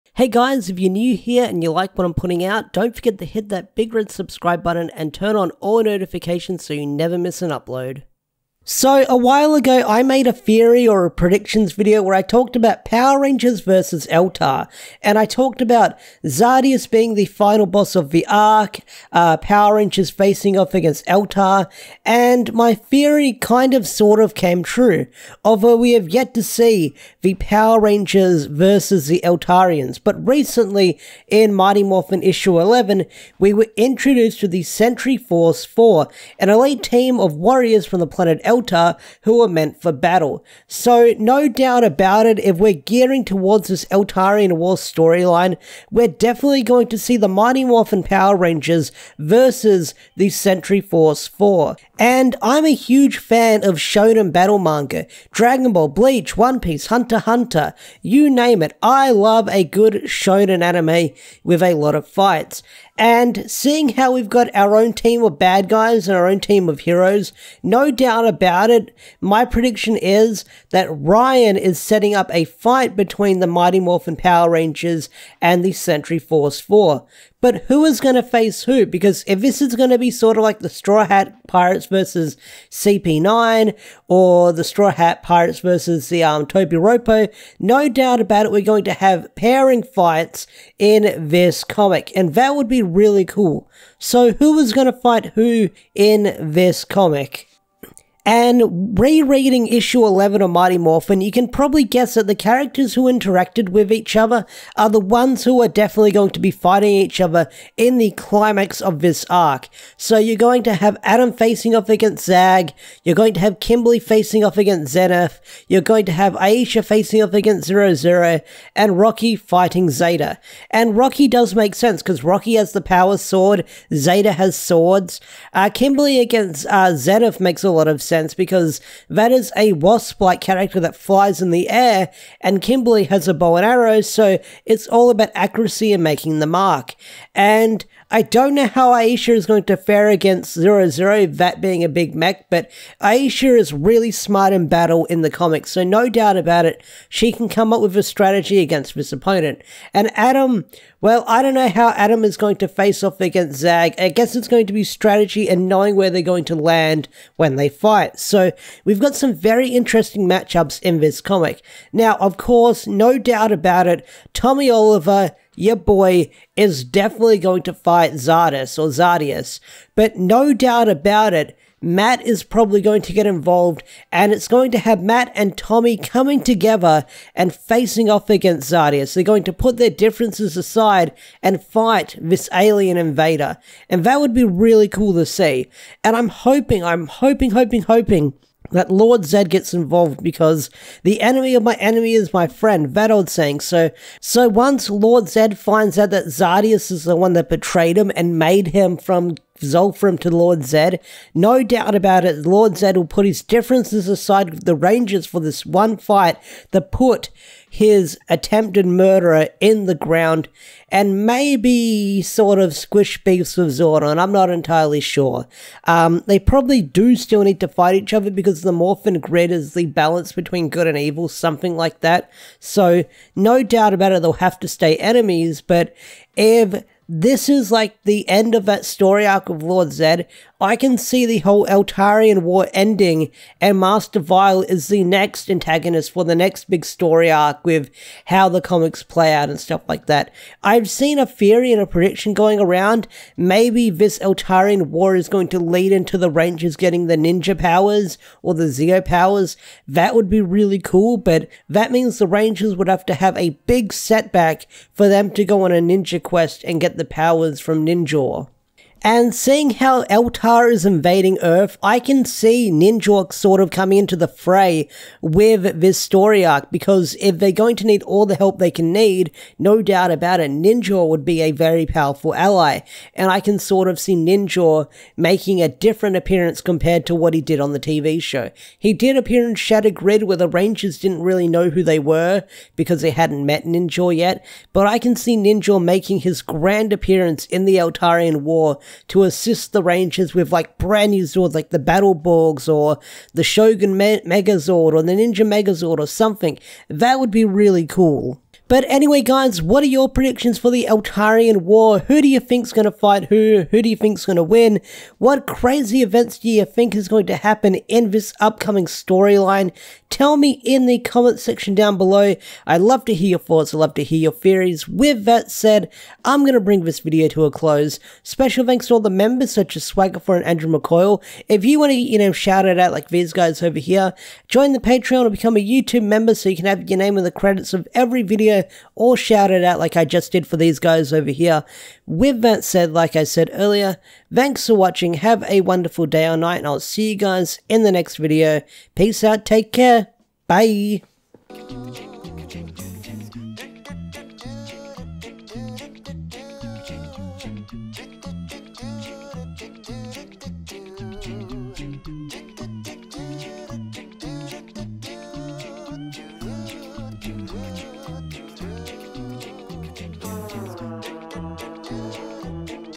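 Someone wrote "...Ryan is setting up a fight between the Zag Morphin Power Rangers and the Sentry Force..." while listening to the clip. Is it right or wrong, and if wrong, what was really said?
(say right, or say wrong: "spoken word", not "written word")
wrong: "Mighty", not "Zag".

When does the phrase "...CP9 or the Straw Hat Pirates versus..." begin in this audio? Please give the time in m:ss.
1:22.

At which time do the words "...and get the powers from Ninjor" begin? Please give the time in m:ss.
4:16.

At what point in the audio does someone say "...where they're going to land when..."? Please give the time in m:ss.
2:35.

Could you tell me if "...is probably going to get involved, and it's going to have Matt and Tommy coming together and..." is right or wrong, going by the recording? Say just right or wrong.
right.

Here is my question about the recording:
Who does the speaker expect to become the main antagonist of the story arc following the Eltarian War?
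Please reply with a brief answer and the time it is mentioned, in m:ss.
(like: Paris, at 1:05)
Master Vile, at 3:53.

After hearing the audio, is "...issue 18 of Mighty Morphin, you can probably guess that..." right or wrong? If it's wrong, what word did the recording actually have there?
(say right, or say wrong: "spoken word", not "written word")
wrong: "11", not "18".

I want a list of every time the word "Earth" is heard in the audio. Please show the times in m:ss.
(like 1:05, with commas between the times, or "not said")
4:21.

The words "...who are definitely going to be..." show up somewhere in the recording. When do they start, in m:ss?
1:45.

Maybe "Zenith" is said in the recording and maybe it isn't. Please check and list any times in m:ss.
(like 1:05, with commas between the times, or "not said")
1:54, 2:06.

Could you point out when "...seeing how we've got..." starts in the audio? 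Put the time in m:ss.
1:03.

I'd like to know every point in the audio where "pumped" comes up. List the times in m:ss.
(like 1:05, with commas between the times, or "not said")
not said.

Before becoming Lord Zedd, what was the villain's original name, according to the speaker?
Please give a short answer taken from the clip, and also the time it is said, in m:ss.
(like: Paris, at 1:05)
Zolfram, at 3:19.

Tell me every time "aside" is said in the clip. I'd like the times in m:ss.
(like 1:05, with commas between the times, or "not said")
3:00, 3:24.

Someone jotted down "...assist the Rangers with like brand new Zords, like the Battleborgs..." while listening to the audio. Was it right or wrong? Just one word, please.
right.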